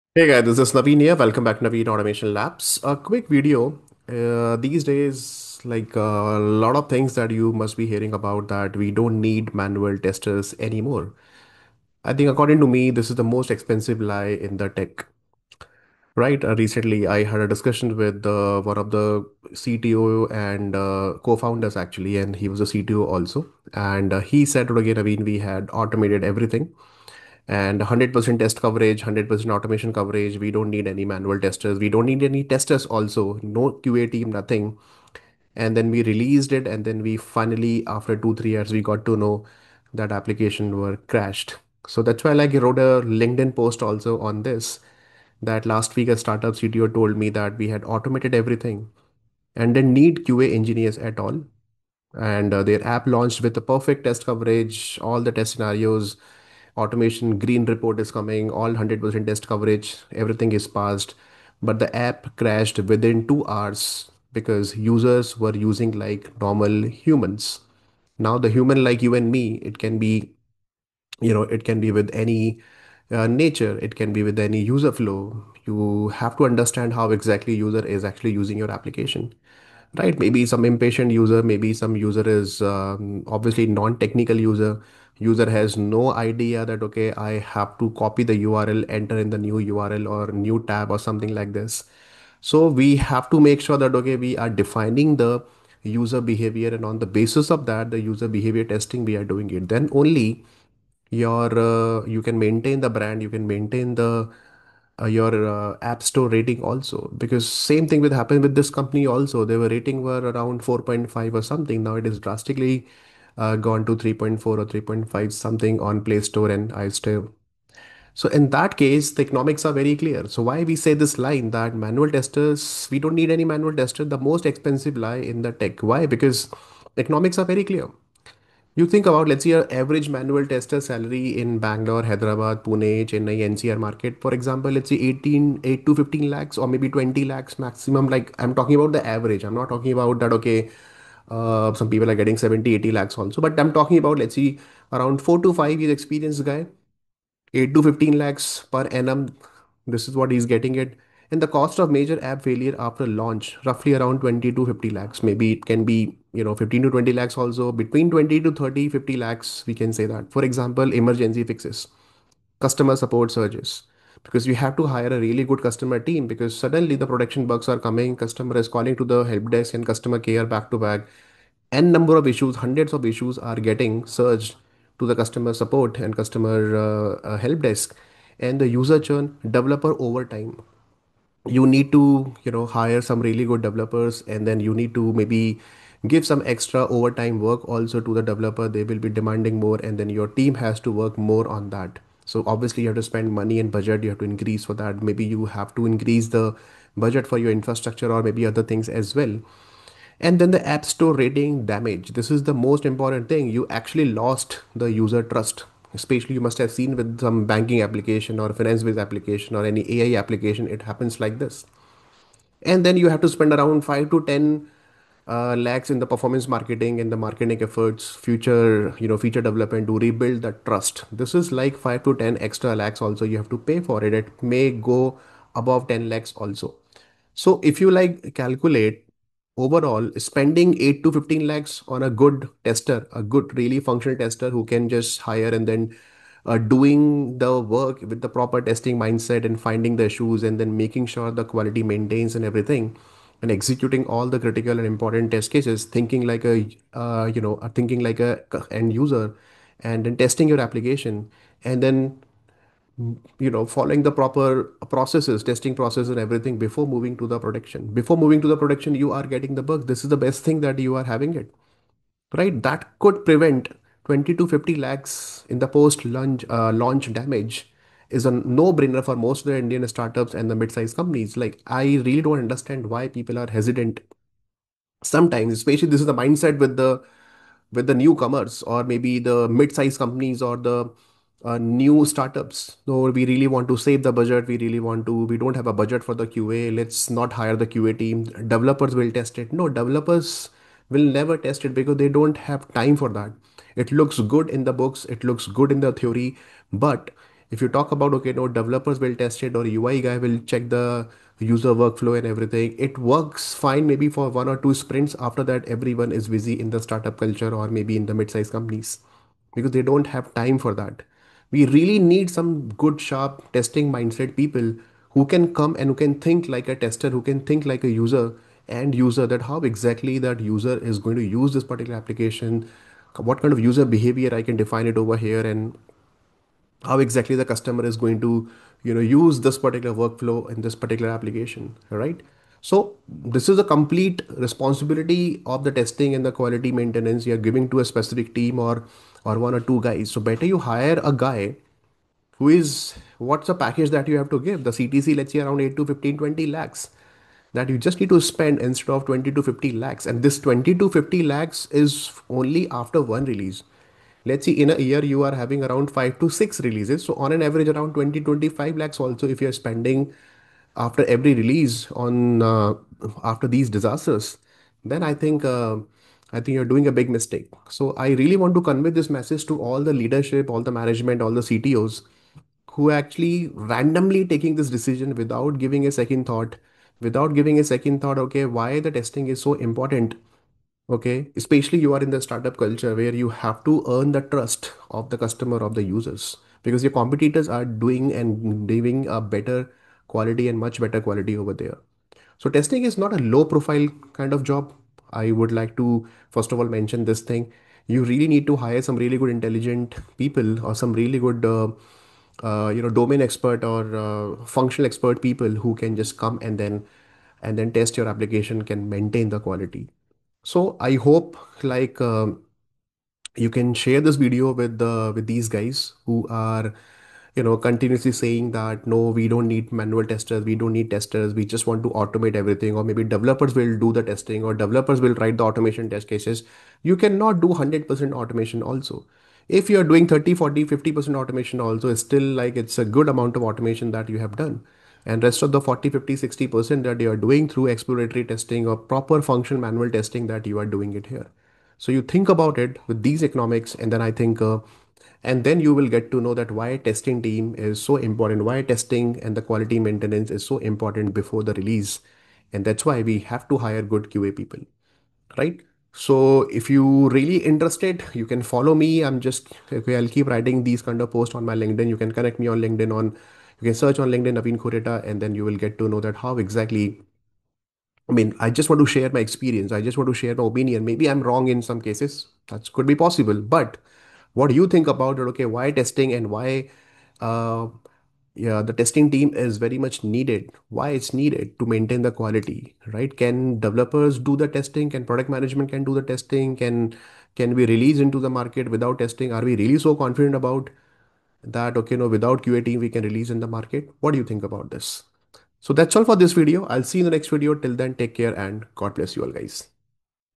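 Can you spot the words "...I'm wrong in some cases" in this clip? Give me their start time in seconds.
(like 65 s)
471 s.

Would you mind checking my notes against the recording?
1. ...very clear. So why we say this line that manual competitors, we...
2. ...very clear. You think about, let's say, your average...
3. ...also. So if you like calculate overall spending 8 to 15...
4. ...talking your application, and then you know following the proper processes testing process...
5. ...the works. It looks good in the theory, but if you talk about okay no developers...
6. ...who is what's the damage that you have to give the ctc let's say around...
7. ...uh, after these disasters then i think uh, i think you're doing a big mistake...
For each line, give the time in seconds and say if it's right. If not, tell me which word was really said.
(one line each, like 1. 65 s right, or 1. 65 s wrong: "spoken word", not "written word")
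1. 119 s wrong: "testers", not "competitors"
2. 127 s right
3. 226 s right
4. 250 s wrong: "testing", not "talking"
5. 294 s wrong: "books", not "works"
6. 342 s wrong: "package", not "damage"
7. 362 s right.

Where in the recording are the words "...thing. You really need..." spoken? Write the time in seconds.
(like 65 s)
397 s.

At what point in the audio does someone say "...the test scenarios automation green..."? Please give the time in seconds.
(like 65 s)
55 s.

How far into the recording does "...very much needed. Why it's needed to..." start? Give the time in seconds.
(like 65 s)
479 s.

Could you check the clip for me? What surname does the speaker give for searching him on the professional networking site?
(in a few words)
Khunteta.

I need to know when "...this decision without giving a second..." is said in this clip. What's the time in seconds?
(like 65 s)
374 s.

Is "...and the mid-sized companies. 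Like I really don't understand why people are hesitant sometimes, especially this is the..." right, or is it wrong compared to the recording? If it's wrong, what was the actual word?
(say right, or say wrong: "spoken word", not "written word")
right.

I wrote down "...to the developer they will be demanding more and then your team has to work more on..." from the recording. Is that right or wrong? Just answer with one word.
right.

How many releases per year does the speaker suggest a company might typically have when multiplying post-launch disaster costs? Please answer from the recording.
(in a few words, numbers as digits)
5 to 6.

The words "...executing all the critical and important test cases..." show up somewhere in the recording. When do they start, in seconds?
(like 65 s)
243 s.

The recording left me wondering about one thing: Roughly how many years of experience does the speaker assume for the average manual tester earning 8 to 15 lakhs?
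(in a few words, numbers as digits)
4 to 5 years.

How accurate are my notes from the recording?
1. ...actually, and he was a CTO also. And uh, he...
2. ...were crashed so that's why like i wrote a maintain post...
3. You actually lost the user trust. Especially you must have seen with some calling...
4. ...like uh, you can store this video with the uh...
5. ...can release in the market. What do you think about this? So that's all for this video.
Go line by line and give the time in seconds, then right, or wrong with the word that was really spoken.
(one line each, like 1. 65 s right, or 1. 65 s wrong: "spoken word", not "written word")
1. 21 s right
2. 40 s wrong: "linkedin", not "maintain"
3. 203 s wrong: "banking", not "calling"
4. 411 s wrong: "share", not "store"
5. 492 s right.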